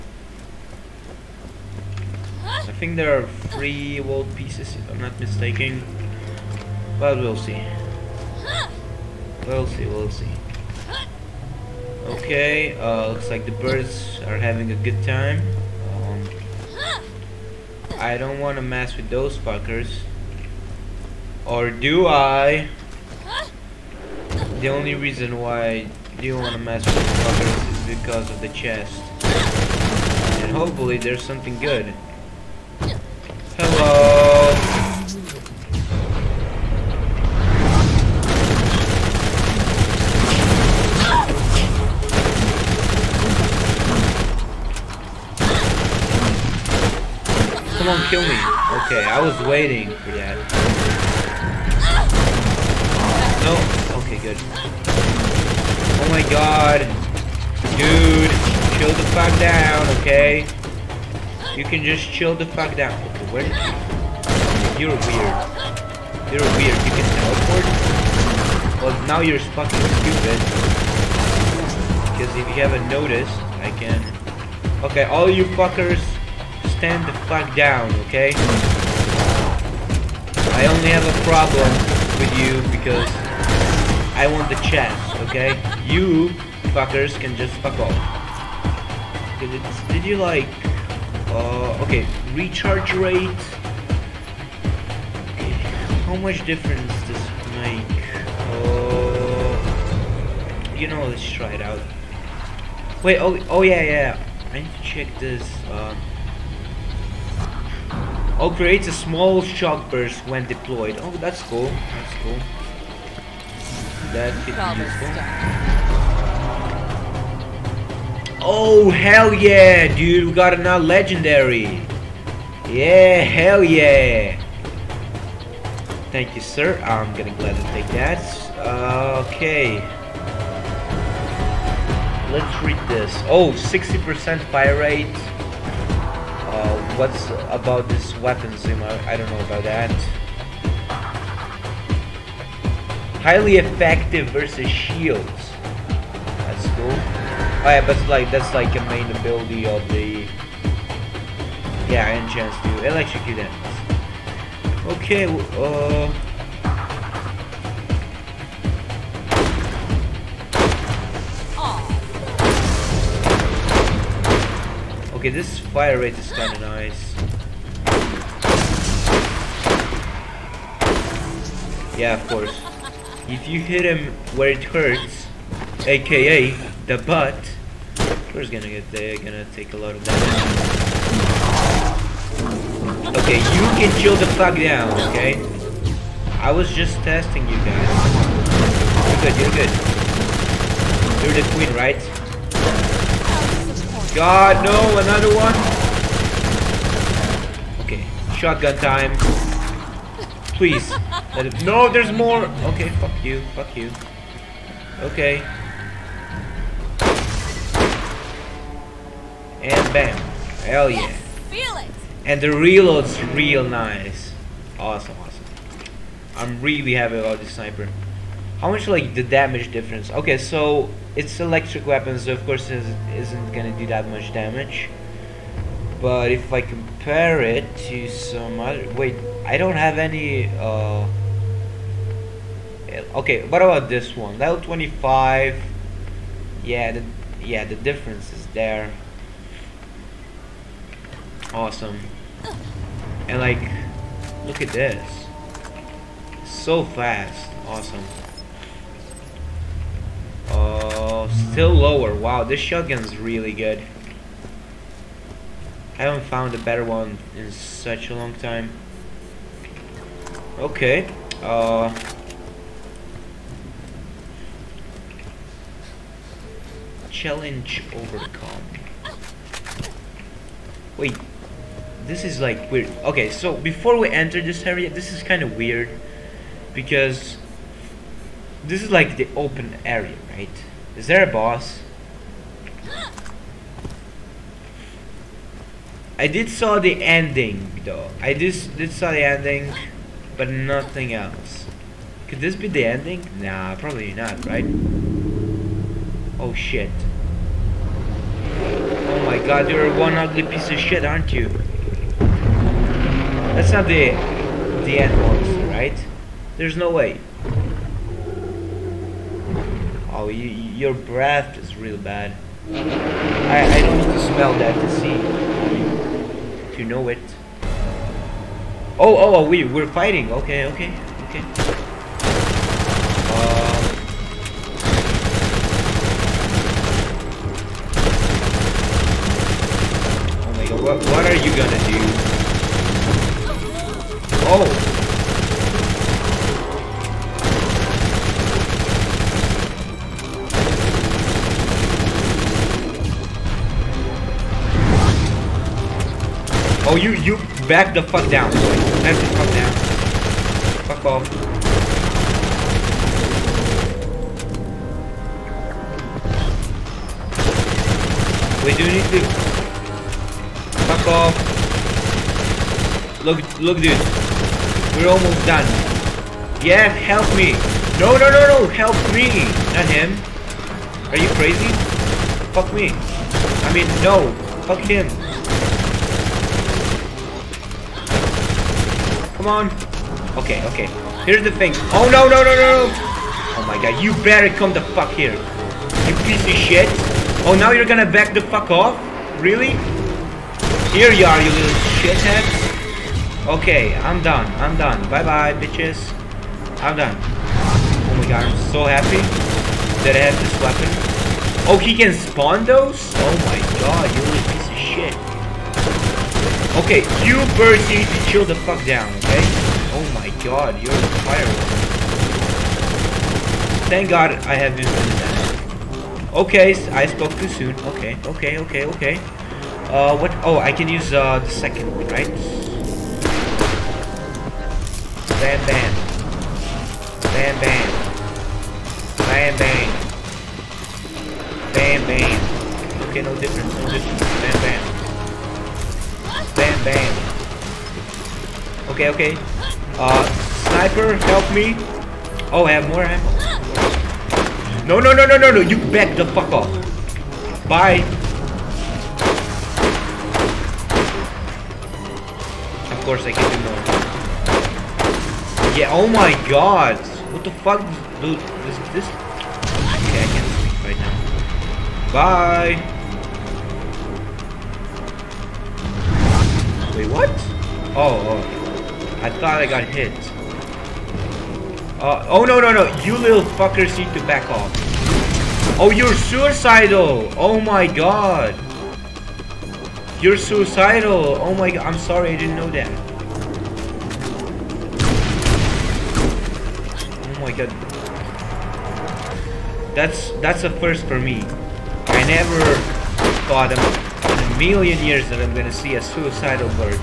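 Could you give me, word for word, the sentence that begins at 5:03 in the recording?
That's not the the end boss, right?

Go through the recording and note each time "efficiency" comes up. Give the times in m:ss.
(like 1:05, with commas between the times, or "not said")
not said.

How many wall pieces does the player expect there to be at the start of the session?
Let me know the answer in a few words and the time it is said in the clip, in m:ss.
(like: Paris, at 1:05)
3, at 0:03.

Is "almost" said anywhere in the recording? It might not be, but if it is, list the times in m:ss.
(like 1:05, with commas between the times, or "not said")
6:05.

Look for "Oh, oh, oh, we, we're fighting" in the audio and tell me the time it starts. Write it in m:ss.
5:18.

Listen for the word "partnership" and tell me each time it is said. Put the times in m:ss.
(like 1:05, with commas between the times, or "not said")
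not said.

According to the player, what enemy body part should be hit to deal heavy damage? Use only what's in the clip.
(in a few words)
The butt.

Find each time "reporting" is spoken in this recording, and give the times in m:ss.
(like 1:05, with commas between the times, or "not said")
not said.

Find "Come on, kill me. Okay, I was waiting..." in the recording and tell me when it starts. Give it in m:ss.
0:47.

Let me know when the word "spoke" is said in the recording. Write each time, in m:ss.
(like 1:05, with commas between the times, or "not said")
6:57.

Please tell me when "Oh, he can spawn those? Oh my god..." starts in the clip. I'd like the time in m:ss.
6:41.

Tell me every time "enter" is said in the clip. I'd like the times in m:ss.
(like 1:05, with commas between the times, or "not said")
4:34.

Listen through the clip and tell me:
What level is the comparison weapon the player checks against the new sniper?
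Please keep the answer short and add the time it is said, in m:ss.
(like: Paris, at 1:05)
25, at 3:54.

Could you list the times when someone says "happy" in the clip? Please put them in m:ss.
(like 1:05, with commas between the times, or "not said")
3:36, 6:38.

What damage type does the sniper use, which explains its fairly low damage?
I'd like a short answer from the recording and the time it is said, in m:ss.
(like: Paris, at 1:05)
Electric, at 3:41.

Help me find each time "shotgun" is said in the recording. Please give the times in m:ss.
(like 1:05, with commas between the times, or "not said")
3:18, 4:12.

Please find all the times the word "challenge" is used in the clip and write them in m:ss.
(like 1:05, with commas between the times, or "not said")
4:27.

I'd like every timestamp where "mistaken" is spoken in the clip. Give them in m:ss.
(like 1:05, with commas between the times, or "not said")
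0:05.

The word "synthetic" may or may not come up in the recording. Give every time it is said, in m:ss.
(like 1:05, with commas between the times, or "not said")
not said.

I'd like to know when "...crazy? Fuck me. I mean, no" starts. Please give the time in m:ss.
6:11.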